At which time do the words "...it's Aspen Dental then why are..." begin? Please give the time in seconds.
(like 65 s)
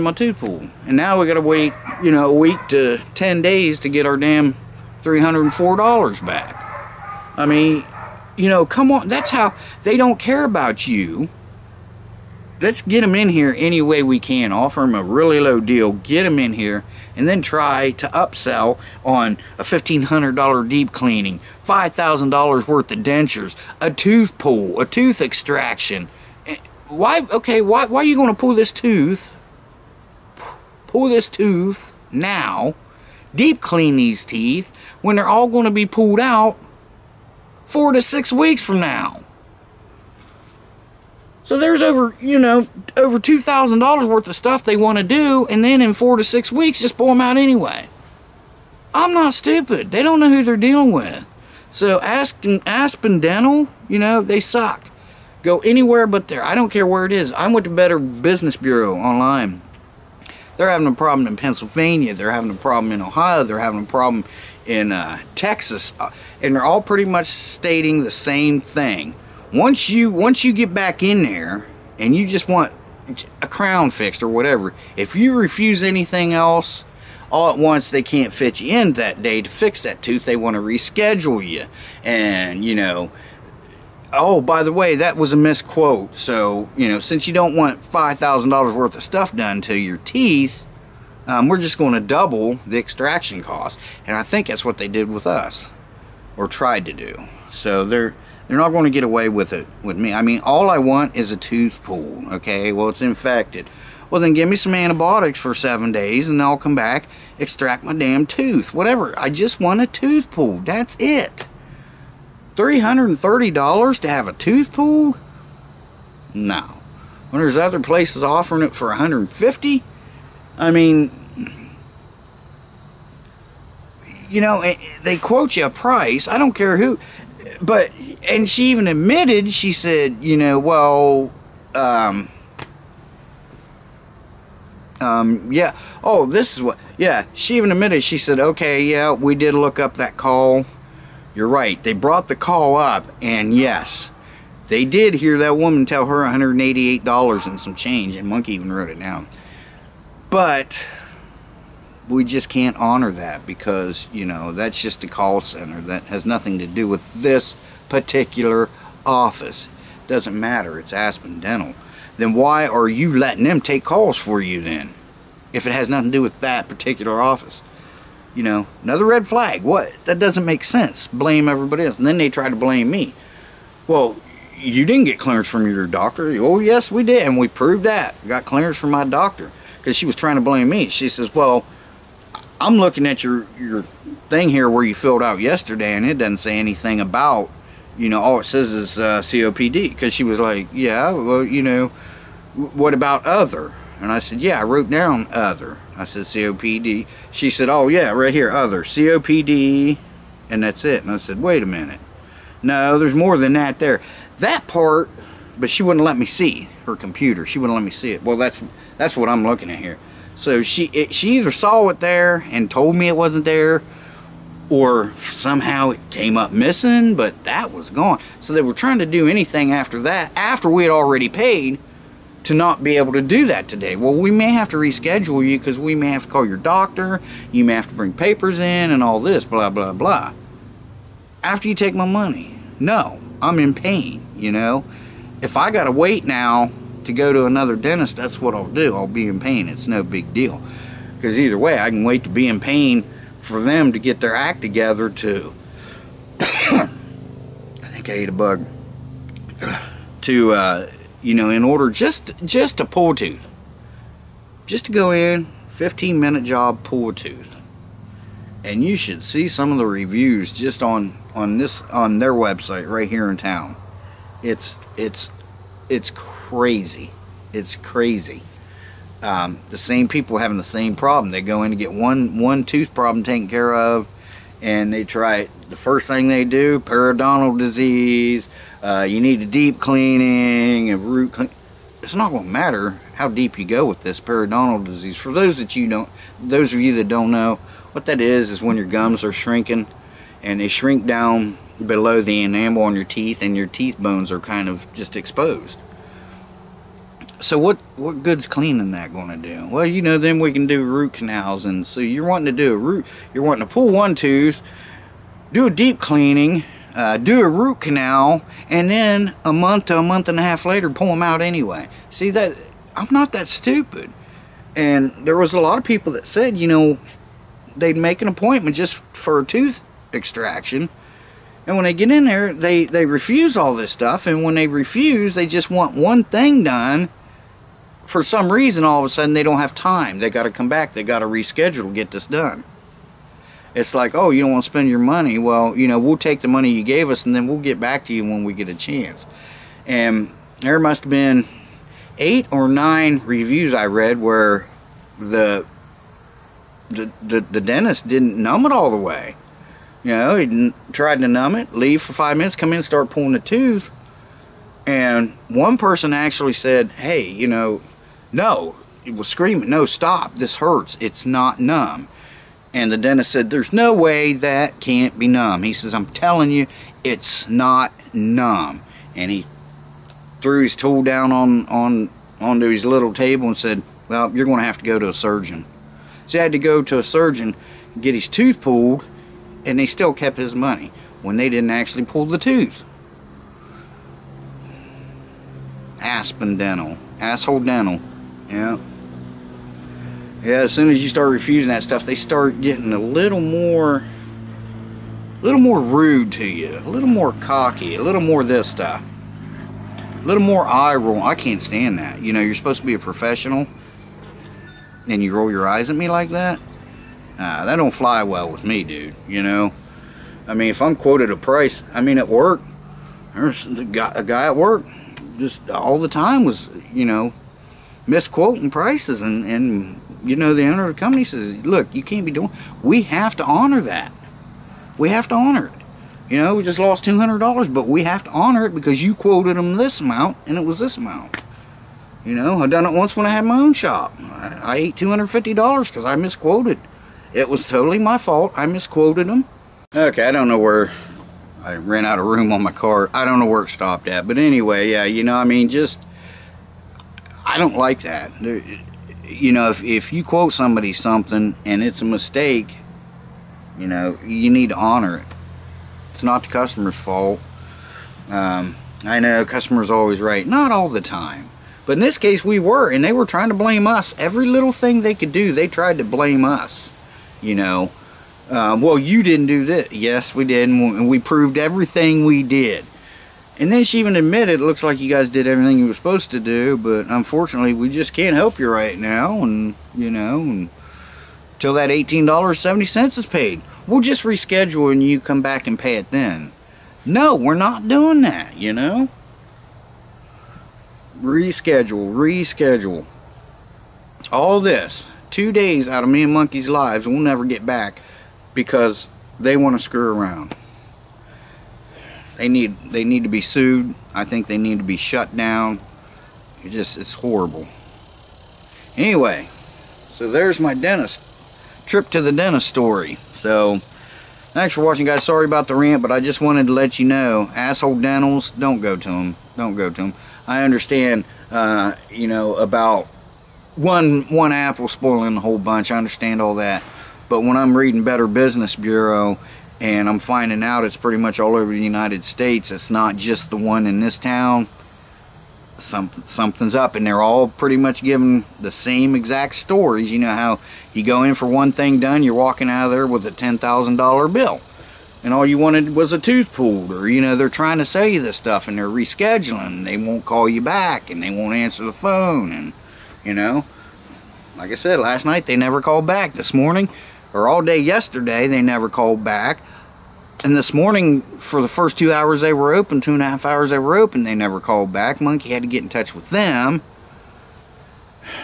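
160 s.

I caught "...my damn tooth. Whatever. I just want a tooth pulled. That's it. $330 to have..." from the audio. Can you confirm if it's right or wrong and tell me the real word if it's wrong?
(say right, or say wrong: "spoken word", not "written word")
right.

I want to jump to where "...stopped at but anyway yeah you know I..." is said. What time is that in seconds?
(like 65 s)
443 s.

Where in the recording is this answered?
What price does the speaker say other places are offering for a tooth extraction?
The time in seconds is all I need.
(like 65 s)
118 s.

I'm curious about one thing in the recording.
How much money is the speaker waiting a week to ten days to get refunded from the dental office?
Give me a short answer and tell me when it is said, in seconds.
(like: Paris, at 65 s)
$304, at 5 s.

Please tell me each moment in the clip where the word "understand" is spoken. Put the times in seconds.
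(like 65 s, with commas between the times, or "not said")
520 s, 525 s.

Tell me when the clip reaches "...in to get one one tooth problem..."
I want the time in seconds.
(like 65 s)
271 s.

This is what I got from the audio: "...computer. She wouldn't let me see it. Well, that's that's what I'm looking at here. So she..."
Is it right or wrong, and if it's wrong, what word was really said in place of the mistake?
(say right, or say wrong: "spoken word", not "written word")
right.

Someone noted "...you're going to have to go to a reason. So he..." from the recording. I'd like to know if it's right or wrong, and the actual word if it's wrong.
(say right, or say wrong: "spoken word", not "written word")
wrong: "surgeon", not "reason".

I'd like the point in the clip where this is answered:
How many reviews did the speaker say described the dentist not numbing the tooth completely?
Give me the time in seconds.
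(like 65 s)
342 s.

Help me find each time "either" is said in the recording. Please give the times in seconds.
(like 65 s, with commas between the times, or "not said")
211 s, 241 s.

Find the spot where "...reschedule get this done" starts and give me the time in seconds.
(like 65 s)
331 s.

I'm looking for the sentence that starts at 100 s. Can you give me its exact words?
I mean, all I want is a tooth pulled.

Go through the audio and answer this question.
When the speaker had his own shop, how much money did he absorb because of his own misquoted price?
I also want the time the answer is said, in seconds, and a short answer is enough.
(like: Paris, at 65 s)
$250, at 434 s.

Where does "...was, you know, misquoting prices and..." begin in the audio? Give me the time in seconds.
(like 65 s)
416 s.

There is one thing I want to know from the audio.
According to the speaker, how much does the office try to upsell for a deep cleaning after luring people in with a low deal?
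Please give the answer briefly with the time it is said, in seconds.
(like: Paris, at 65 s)
$1,500, at 19 s.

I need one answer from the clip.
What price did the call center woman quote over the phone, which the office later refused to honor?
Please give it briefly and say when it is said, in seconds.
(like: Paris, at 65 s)
$188, at 146 s.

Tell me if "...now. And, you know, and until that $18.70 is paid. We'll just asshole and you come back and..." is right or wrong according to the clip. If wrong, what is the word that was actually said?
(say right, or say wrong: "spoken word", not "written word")
wrong: "reschedule", not "asshole".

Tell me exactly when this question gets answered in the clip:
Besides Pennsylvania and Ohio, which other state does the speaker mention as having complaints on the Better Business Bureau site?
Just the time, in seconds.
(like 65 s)
65 s.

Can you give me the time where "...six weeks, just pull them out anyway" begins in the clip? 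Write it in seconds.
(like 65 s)
46 s.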